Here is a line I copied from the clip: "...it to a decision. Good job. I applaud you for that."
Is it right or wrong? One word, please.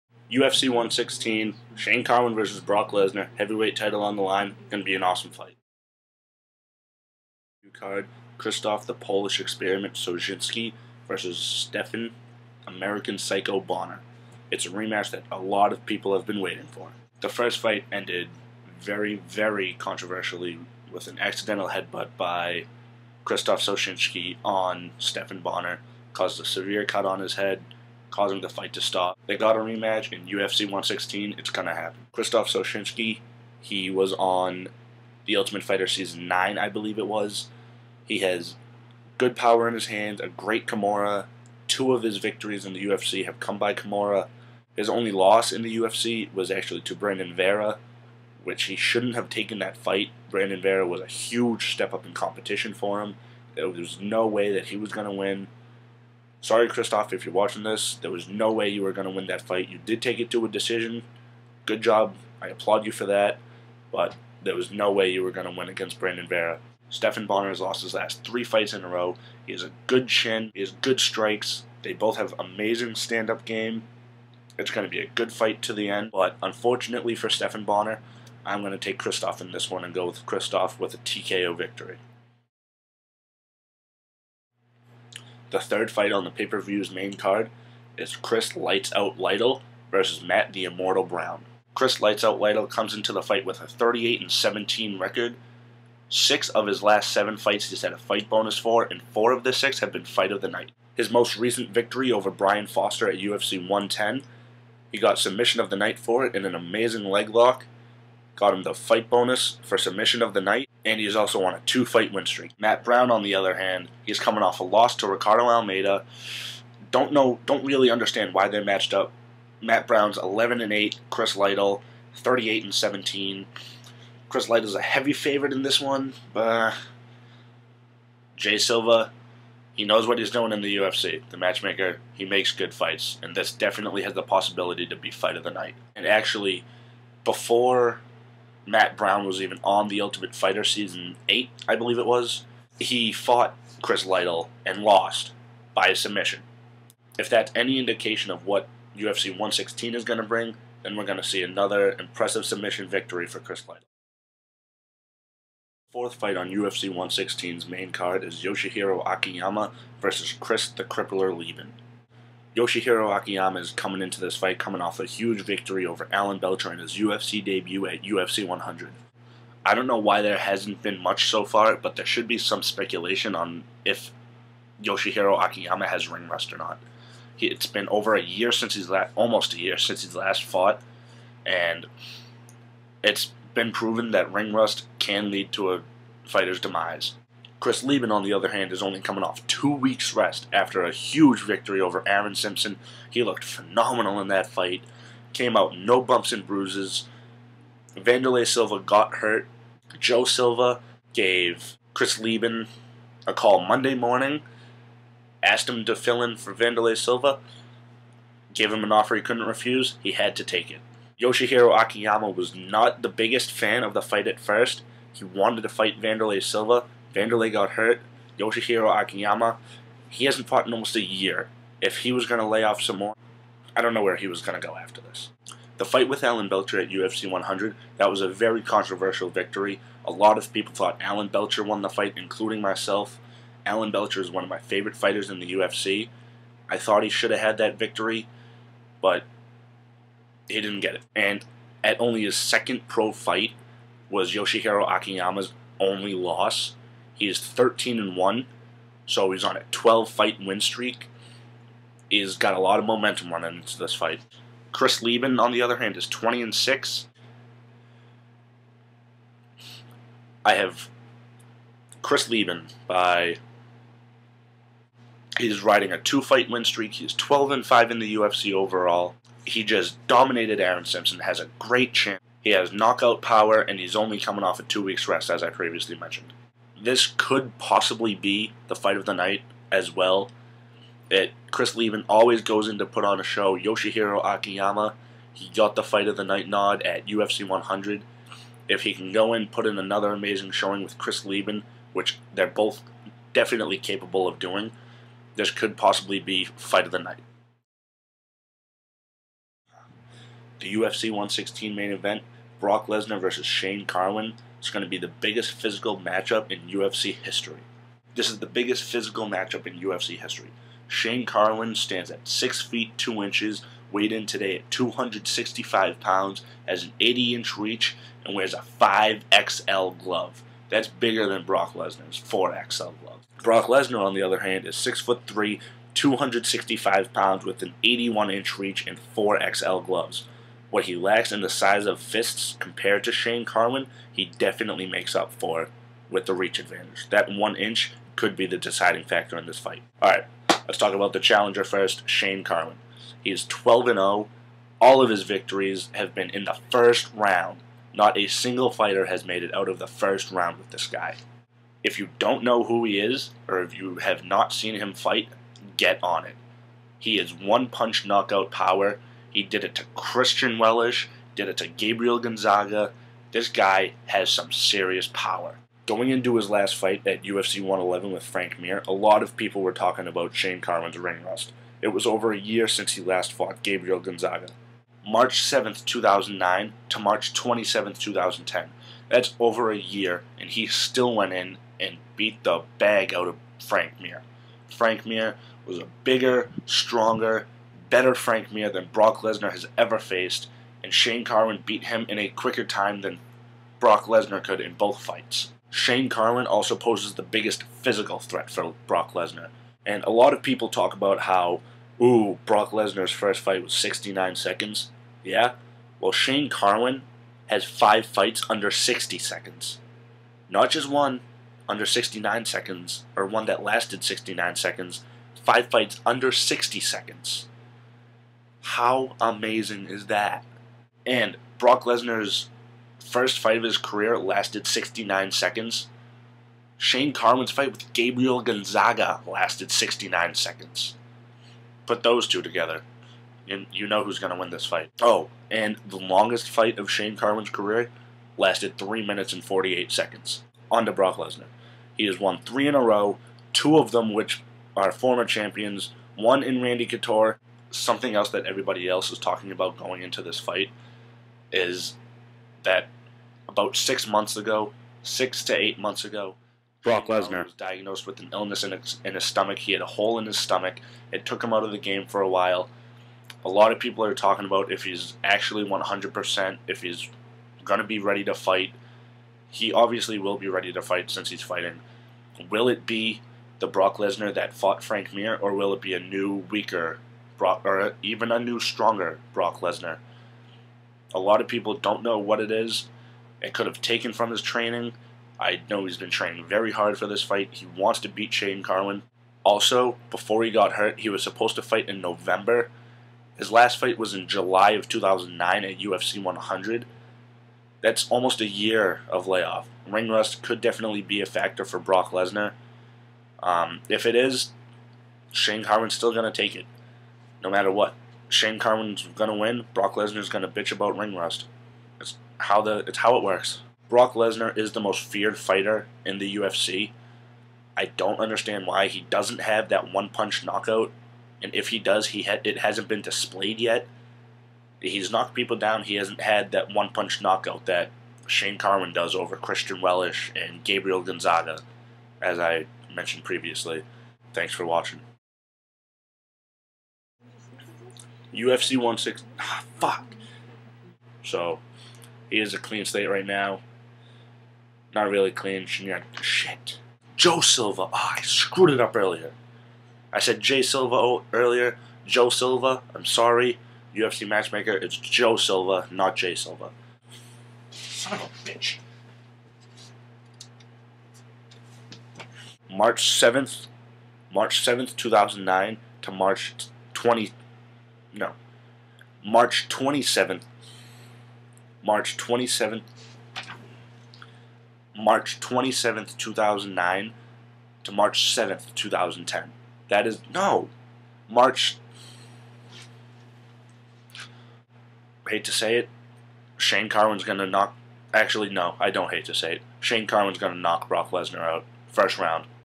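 right.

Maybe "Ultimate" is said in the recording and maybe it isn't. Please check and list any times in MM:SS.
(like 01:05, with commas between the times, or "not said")
00:35, 02:20.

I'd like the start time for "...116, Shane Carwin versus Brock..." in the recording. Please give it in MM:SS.
00:00.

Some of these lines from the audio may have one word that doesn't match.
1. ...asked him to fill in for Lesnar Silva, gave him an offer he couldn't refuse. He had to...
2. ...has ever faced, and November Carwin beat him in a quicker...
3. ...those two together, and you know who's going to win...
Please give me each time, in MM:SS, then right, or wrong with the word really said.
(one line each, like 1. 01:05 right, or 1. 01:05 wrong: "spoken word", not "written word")
1. 03:25 wrong: "Vanderlei", not "Lesnar"
2. 06:29 wrong: "Shane", not "November"
3. 07:12 right.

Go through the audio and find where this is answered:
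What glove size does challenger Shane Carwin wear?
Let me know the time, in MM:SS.
05:18.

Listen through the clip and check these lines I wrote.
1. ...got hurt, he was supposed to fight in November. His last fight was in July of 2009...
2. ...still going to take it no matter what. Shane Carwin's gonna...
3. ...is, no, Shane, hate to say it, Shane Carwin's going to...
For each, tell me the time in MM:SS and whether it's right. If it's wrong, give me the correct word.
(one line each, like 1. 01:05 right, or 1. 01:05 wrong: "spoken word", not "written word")
1. 08:10 right
2. 08:25 right
3. 09:40 wrong: "March", not "Shane".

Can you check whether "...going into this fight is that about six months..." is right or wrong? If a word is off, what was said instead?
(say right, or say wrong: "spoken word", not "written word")
right.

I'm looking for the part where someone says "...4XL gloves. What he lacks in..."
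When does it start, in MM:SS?
05:29.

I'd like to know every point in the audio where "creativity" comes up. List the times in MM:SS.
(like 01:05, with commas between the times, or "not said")
not said.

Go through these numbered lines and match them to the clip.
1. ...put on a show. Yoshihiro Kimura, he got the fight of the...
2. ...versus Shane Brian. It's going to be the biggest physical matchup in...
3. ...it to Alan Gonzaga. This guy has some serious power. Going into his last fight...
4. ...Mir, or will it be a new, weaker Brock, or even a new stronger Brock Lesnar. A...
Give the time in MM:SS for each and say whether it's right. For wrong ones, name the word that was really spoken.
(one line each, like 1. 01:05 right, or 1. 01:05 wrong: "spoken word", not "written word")
1. 04:42 wrong: "Akiyama", not "Kimura"
2. 05:03 wrong: "Carwin", not "Brian"
3. 06:01 wrong: "Gabriel", not "Alan"
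4. 07:55 right.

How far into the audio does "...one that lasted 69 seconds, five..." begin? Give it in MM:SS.
06:53.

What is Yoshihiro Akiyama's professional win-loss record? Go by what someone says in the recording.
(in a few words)
13 and 1.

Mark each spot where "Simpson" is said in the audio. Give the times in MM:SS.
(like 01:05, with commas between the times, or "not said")
03:12, 04:30.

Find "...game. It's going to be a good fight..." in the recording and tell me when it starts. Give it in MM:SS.
01:13.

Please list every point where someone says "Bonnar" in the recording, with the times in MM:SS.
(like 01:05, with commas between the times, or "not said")
00:13, 00:25, 01:07, 01:17.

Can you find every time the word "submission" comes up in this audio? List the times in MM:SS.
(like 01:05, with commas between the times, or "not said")
01:45, 01:49, 02:25, 02:32.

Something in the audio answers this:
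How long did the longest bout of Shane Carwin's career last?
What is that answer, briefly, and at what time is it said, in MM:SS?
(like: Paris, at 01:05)
3 minutes 48 seconds, at 07:18.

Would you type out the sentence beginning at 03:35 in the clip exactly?
He wanted to fight Vanderlei Silva.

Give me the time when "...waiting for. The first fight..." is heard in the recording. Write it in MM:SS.
00:16.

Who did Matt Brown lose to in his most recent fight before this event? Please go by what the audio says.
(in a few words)
Ricardo Almeida.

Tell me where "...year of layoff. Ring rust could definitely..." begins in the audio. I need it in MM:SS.
08:18.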